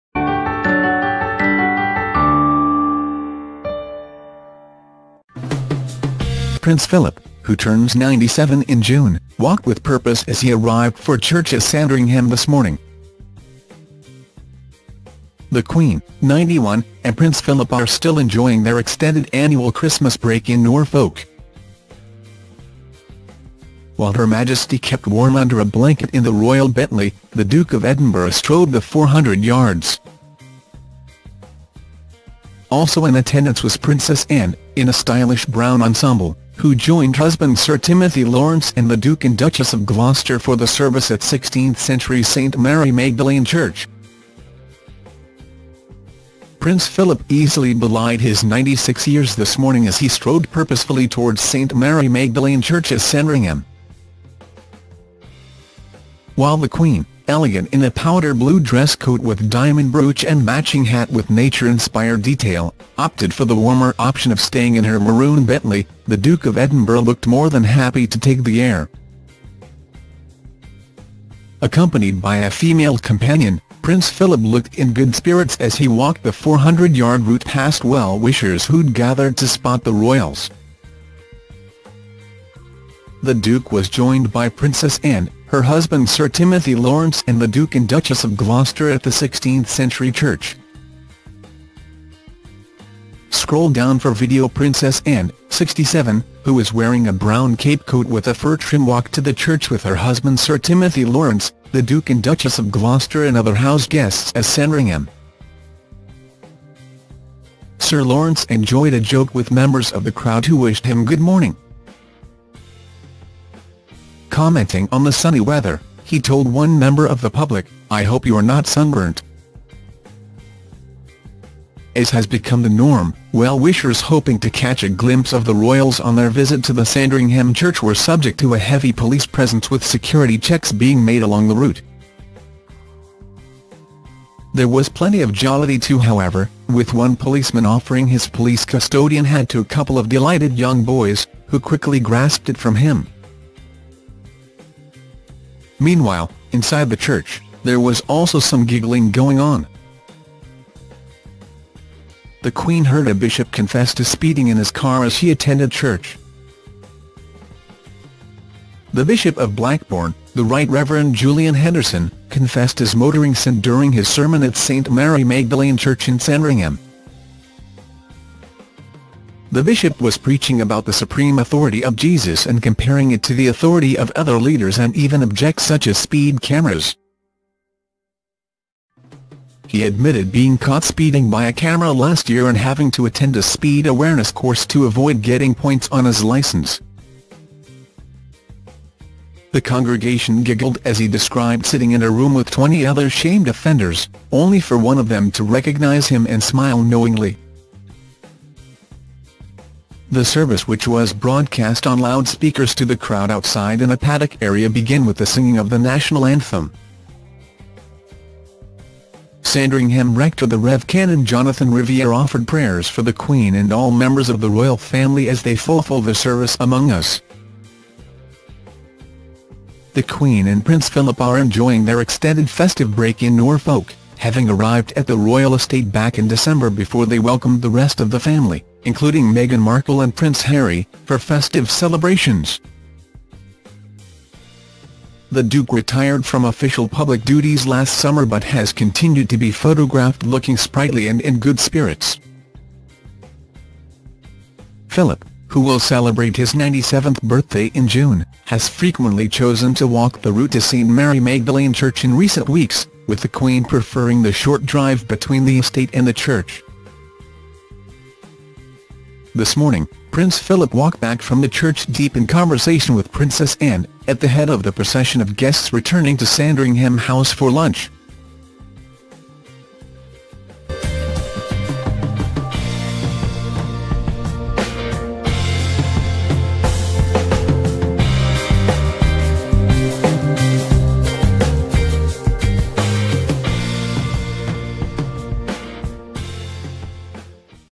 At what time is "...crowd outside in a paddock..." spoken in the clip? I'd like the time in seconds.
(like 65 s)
202 s.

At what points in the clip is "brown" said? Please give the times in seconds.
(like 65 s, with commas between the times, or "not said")
35 s, 97 s.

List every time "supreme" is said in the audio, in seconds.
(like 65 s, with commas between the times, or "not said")
170 s.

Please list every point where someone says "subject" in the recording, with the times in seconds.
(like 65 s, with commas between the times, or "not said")
127 s.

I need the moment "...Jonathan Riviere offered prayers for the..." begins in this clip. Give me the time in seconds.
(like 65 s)
211 s.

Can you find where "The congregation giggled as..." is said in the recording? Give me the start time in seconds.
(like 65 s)
189 s.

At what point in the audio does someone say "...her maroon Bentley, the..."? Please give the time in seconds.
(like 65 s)
64 s.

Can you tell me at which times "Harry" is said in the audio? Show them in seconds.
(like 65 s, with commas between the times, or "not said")
230 s.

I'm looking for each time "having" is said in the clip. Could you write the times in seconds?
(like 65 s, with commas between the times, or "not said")
182 s, 224 s.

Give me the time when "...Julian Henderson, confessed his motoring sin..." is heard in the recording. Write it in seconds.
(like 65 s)
161 s.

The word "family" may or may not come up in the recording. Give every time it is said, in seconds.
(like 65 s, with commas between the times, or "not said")
214 s, 228 s.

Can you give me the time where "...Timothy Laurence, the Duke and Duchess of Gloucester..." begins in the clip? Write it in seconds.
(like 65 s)
100 s.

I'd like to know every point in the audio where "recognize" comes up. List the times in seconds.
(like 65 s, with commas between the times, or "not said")
195 s.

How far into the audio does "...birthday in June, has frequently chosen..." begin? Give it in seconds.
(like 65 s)
247 s.